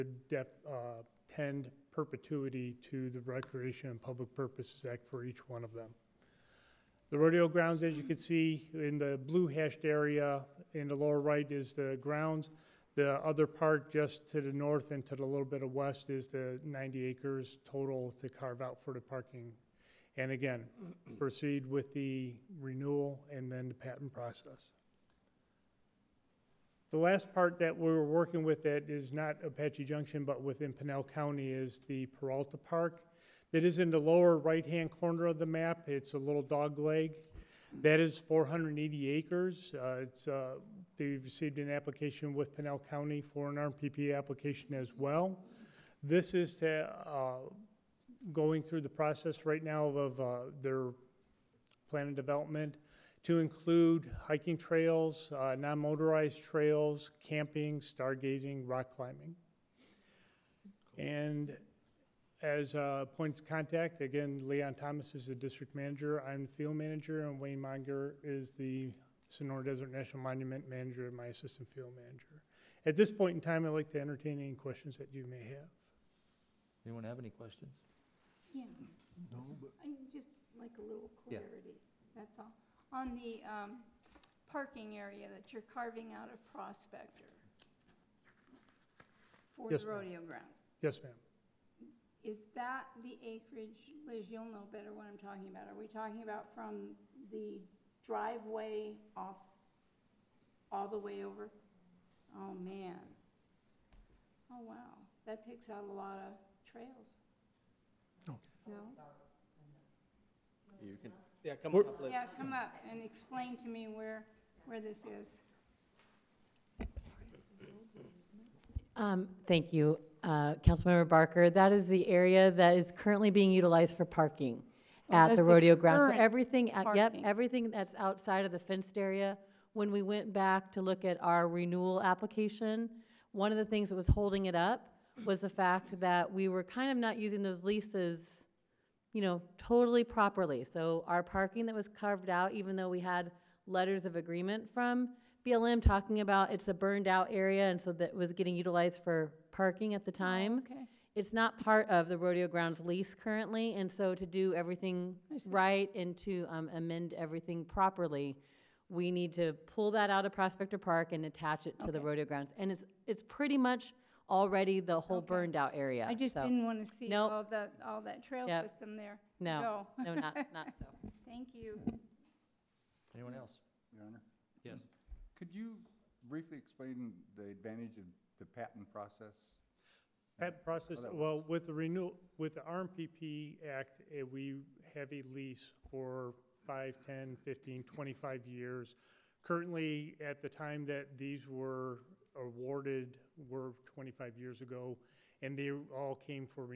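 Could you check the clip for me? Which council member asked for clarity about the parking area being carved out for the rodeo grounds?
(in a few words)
Barker.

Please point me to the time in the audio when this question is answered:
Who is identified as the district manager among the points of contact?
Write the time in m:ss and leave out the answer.
1:04.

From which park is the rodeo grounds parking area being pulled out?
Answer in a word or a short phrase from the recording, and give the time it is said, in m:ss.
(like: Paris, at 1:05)
Prospector Park, at 2:40.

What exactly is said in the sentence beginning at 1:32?
is that the acreage, Liz, you'll know better what I'm talking about.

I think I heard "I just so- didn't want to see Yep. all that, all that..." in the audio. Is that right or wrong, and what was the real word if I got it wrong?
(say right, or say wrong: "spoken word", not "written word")
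wrong: "Nope", not "Yep".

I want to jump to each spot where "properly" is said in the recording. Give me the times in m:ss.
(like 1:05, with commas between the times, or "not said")
2:20, 2:37.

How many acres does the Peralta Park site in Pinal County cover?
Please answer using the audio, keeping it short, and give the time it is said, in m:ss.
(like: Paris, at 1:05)
480 acres, at 0:38.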